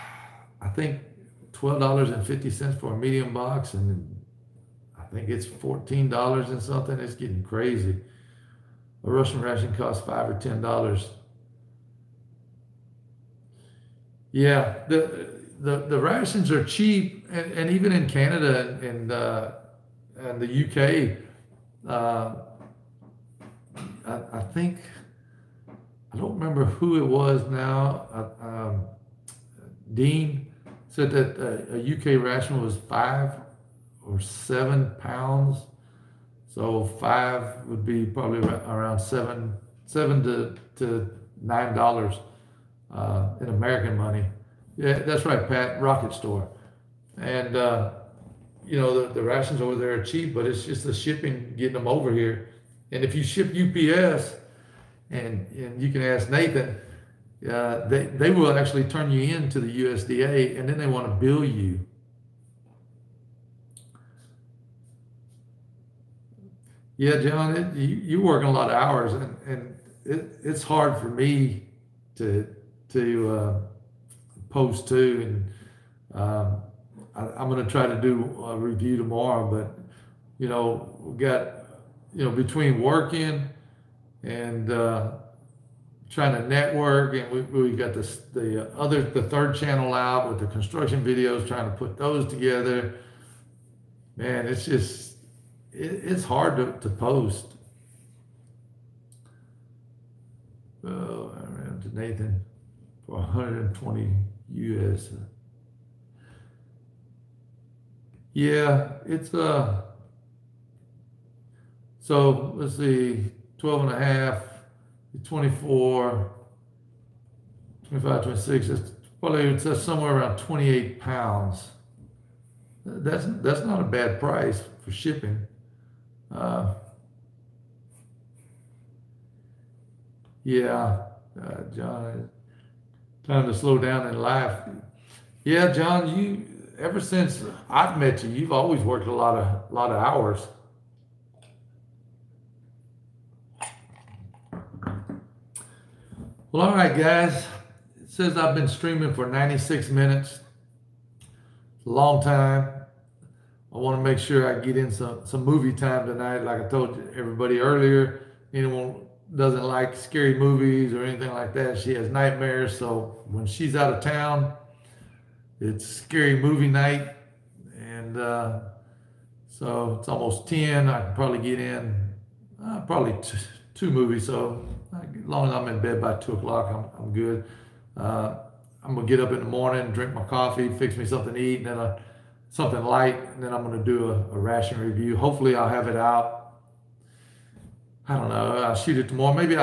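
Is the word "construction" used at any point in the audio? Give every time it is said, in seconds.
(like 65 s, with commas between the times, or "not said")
90 s.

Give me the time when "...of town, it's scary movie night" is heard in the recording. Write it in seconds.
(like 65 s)
163 s.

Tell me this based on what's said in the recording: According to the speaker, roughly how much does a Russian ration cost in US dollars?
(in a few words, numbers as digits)
5 or 10 dollars.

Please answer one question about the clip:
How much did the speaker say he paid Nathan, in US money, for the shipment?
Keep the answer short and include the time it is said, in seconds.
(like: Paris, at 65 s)
120, at 103 s.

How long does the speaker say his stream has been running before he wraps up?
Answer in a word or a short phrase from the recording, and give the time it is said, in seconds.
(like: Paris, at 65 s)
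96 minutes, at 149 s.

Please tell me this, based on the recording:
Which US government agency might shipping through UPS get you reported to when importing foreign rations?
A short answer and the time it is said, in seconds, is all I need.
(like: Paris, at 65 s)
USDA, at 59 s.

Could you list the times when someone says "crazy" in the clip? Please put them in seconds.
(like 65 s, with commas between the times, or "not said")
7 s.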